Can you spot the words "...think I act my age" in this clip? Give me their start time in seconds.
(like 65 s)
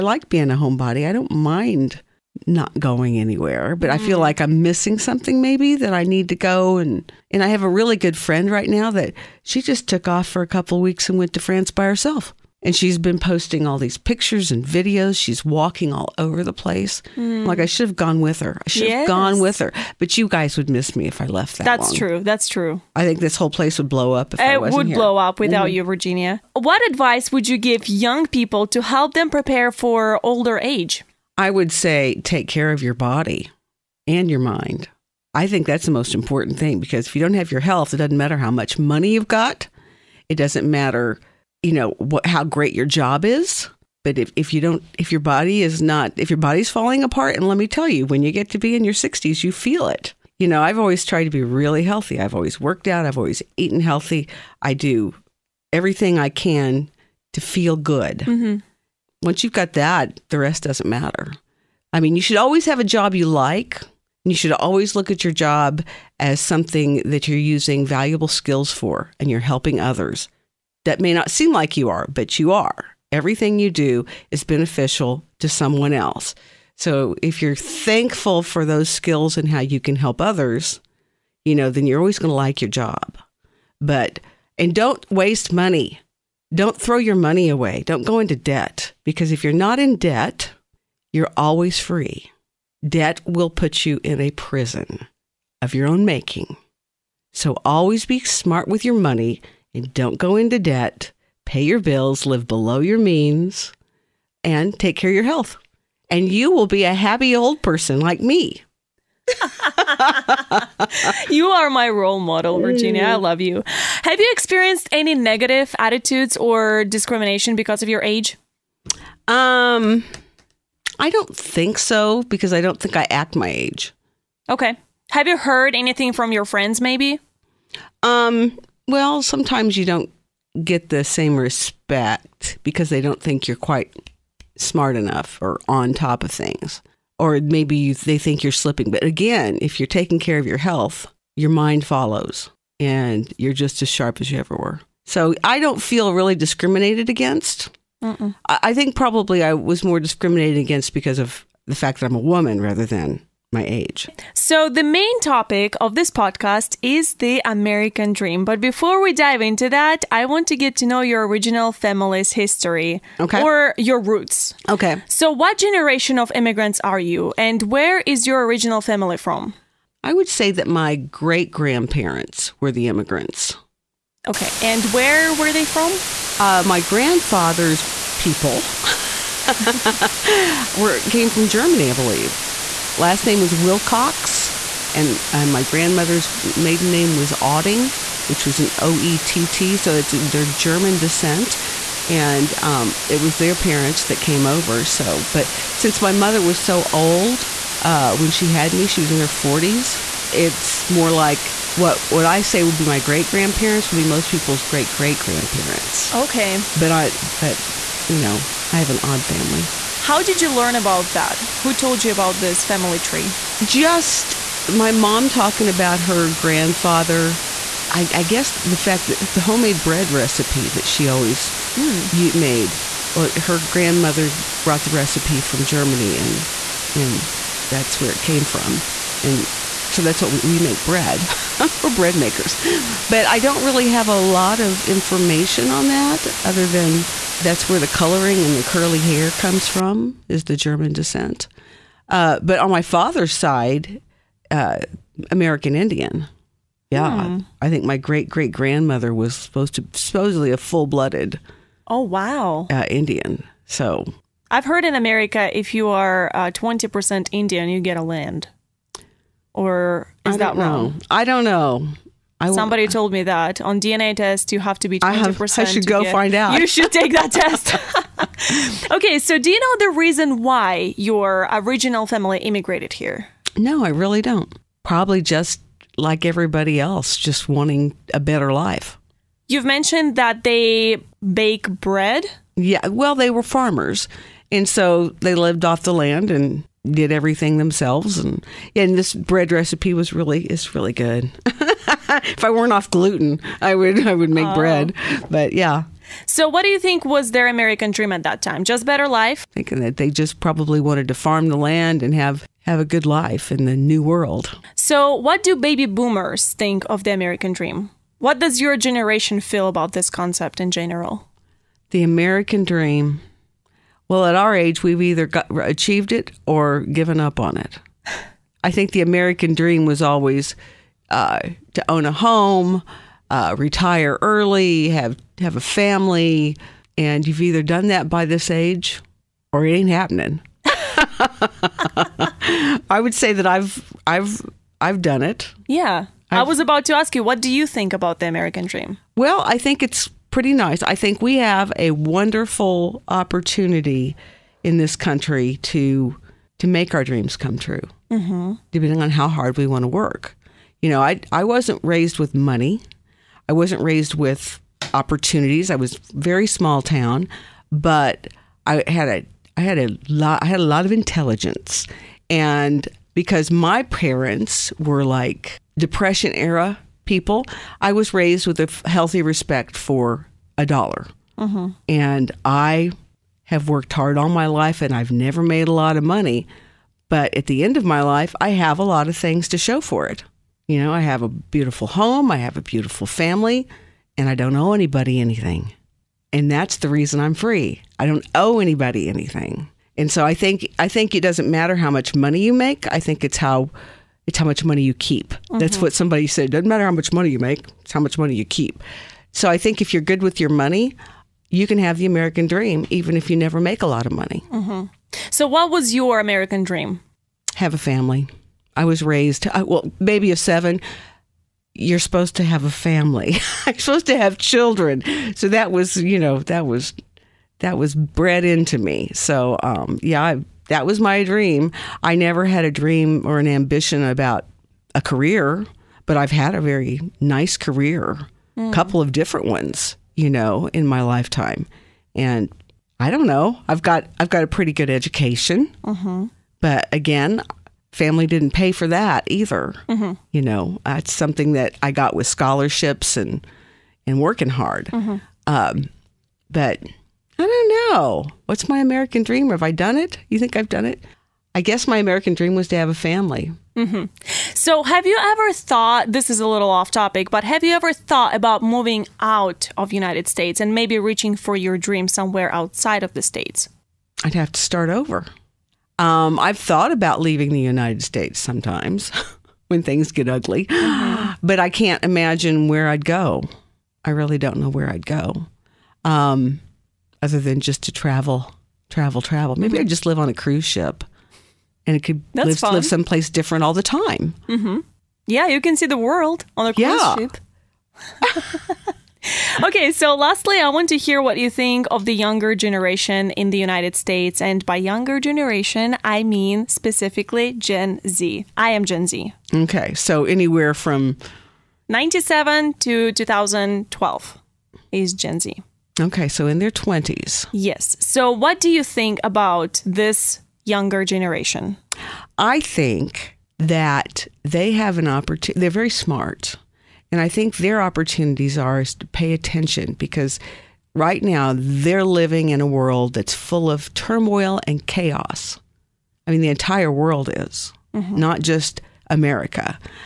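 122 s.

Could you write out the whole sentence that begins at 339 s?
Well, I think it's pretty nice.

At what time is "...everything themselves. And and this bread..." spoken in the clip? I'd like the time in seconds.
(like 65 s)
287 s.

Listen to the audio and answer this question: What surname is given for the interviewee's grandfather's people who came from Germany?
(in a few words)
Wilcox.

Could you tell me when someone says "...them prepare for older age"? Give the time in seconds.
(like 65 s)
29 s.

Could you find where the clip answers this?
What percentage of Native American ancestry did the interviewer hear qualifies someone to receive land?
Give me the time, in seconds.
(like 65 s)
256 s.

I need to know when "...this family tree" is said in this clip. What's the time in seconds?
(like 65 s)
212 s.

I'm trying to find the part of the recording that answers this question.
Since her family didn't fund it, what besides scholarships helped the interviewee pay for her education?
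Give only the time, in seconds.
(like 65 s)
444 s.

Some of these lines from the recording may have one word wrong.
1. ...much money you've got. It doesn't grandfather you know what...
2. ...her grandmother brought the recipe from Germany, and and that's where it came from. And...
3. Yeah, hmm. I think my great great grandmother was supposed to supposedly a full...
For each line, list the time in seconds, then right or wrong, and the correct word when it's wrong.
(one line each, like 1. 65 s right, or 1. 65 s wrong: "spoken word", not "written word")
1. 38 s wrong: "matter", not "grandfather"
2. 223 s right
3. 246 s right.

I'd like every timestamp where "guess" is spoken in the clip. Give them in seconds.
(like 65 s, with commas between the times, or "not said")
218 s, 451 s.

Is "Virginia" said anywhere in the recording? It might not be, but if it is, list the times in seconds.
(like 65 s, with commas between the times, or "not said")
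25 s, 112 s.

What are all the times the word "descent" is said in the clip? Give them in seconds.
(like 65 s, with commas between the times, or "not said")
190 s, 240 s.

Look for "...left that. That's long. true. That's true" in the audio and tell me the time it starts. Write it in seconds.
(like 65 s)
21 s.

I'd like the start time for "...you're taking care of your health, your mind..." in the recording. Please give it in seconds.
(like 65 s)
139 s.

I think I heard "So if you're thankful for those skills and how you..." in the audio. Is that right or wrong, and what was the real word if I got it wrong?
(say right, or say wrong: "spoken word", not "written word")
right.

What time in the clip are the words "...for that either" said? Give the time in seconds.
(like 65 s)
438 s.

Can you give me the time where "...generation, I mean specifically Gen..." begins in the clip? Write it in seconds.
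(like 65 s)
495 s.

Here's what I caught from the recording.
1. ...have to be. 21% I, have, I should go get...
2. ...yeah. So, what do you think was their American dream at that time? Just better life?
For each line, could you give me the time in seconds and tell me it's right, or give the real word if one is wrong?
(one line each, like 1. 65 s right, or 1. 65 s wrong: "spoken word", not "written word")
1. 264 s wrong: "20", not "21"
2. 295 s right.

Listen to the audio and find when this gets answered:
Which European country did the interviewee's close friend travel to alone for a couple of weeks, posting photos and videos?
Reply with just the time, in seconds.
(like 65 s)
11 s.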